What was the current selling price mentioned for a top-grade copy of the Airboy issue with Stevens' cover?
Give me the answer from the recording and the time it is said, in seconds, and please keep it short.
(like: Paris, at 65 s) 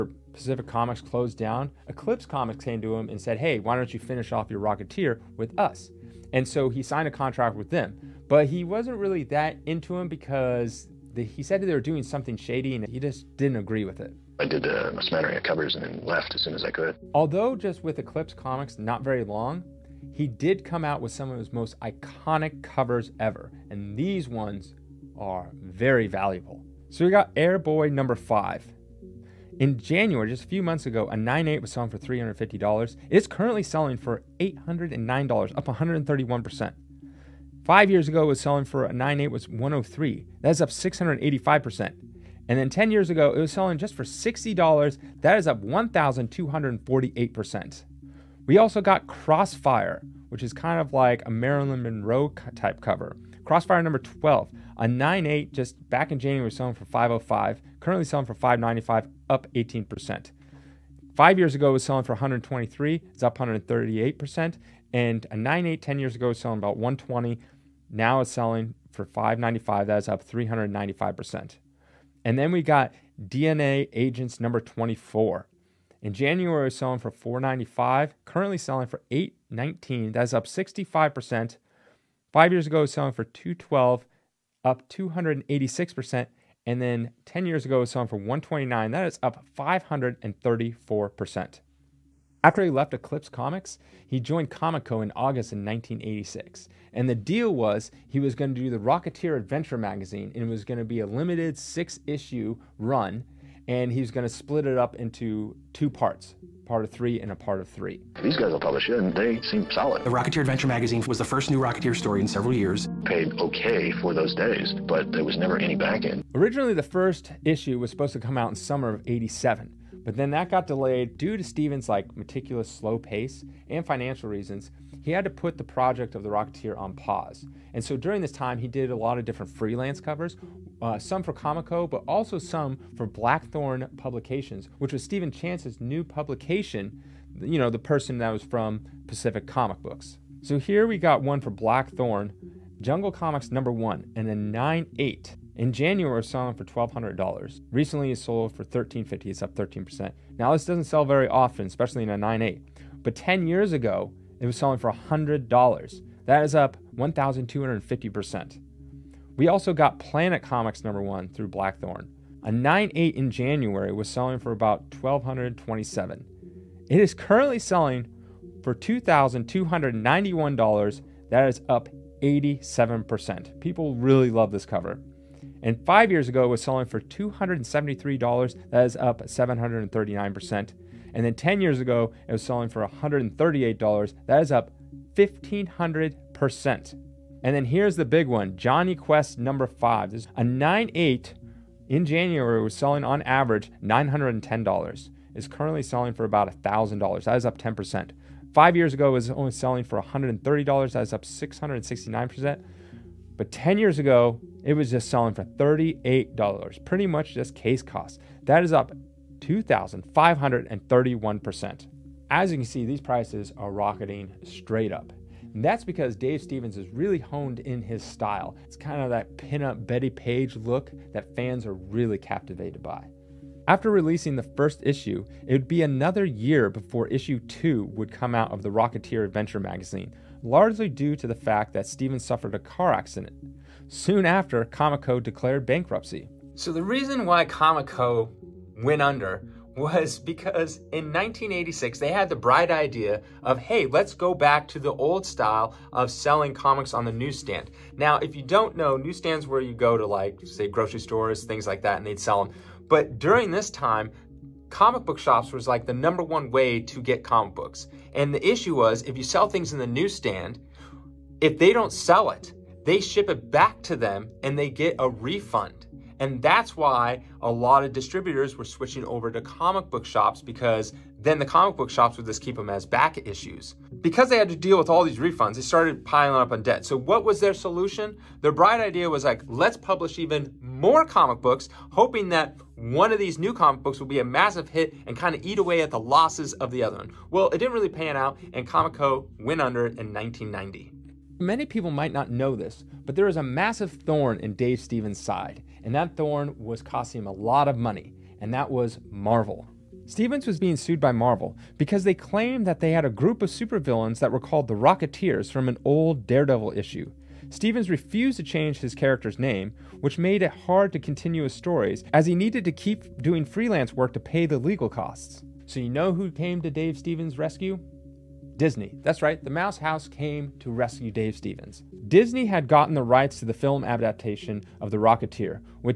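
$809, at 34 s.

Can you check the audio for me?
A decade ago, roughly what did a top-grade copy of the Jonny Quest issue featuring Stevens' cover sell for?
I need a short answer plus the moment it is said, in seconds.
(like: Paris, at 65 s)
$38, at 205 s.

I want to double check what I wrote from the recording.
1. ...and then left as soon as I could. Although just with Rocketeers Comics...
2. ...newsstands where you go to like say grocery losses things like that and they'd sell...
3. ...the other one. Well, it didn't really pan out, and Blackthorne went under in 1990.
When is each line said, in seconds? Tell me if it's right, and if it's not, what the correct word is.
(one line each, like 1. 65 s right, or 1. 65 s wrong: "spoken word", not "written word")
1. 15 s wrong: "Eclipse", not "Rocketeers"
2. 248 s wrong: "stores", not "losses"
3. 286 s wrong: "Comico", not "Blackthorne".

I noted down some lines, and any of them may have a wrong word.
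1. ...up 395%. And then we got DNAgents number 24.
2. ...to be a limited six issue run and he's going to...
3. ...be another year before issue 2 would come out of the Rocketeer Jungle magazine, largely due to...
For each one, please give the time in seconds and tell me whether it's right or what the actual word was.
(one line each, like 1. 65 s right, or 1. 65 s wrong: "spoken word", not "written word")
1. 70 s right
2. 100 s right
3. 225 s wrong: "Adventure", not "Jungle".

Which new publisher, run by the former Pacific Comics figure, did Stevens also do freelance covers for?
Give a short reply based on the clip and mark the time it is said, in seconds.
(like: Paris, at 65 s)
Blackthorne Publications, at 133 s.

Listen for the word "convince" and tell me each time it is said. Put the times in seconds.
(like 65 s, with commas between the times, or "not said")
not said.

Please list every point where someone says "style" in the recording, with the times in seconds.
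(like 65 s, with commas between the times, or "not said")
218 s, 245 s.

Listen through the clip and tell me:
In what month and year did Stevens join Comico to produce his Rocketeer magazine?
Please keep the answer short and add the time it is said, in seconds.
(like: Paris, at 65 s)
August 1986, at 95 s.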